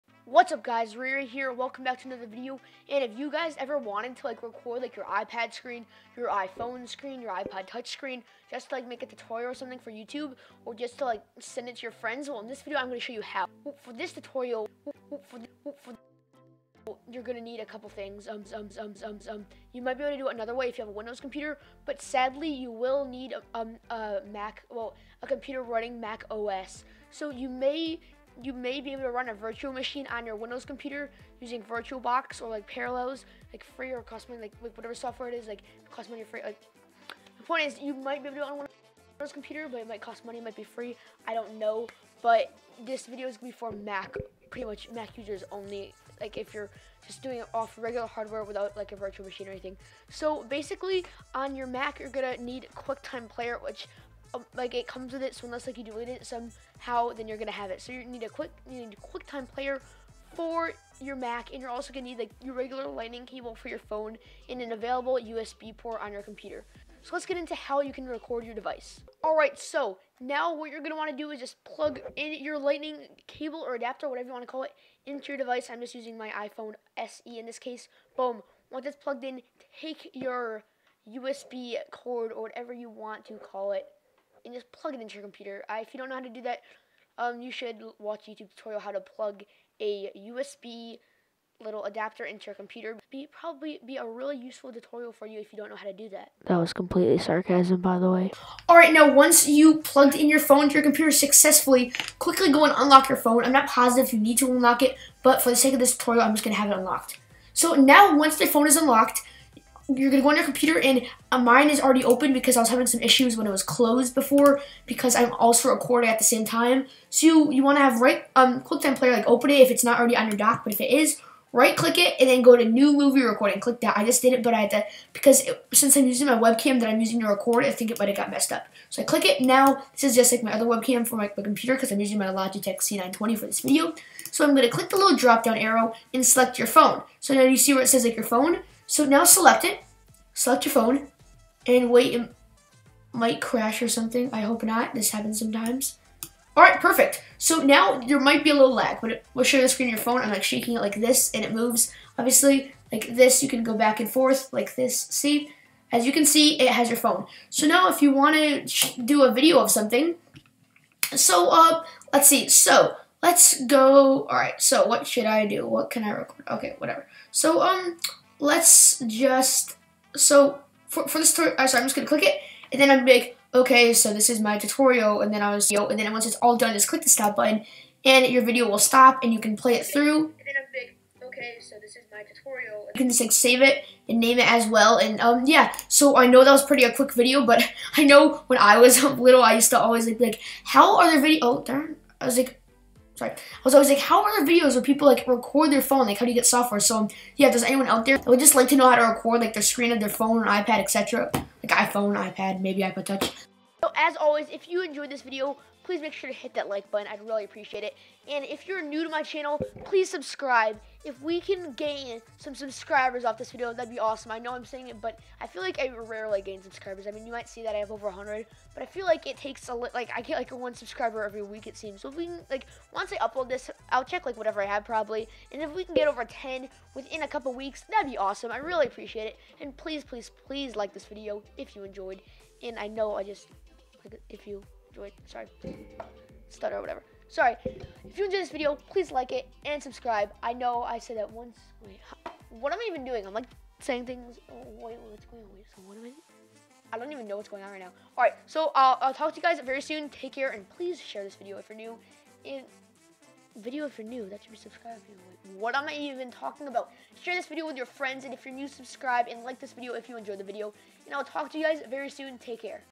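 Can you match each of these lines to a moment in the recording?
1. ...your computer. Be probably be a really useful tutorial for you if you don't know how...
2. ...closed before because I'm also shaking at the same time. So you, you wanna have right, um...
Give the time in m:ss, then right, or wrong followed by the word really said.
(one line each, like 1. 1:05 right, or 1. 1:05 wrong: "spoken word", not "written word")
1. 1:32 right
2. 1:53 wrong: "recording", not "shaking".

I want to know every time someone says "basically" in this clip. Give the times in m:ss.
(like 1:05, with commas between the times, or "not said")
0:50.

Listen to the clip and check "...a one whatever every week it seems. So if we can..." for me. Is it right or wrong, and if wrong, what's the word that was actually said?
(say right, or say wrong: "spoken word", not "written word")
wrong: "subscriber", not "whatever".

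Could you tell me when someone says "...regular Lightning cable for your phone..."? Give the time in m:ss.
1:02.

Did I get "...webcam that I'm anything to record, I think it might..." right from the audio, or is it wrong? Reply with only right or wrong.
wrong.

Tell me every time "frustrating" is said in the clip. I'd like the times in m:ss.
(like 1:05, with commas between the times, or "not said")
not said.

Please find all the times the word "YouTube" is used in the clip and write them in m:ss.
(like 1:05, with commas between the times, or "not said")
0:09, 1:28.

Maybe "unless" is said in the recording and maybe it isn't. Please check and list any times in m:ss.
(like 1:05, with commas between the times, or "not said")
0:55.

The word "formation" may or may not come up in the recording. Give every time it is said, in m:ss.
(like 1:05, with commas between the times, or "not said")
not said.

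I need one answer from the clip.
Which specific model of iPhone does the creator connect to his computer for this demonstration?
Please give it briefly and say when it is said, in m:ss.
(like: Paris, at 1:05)
iPhone SE, at 1:16.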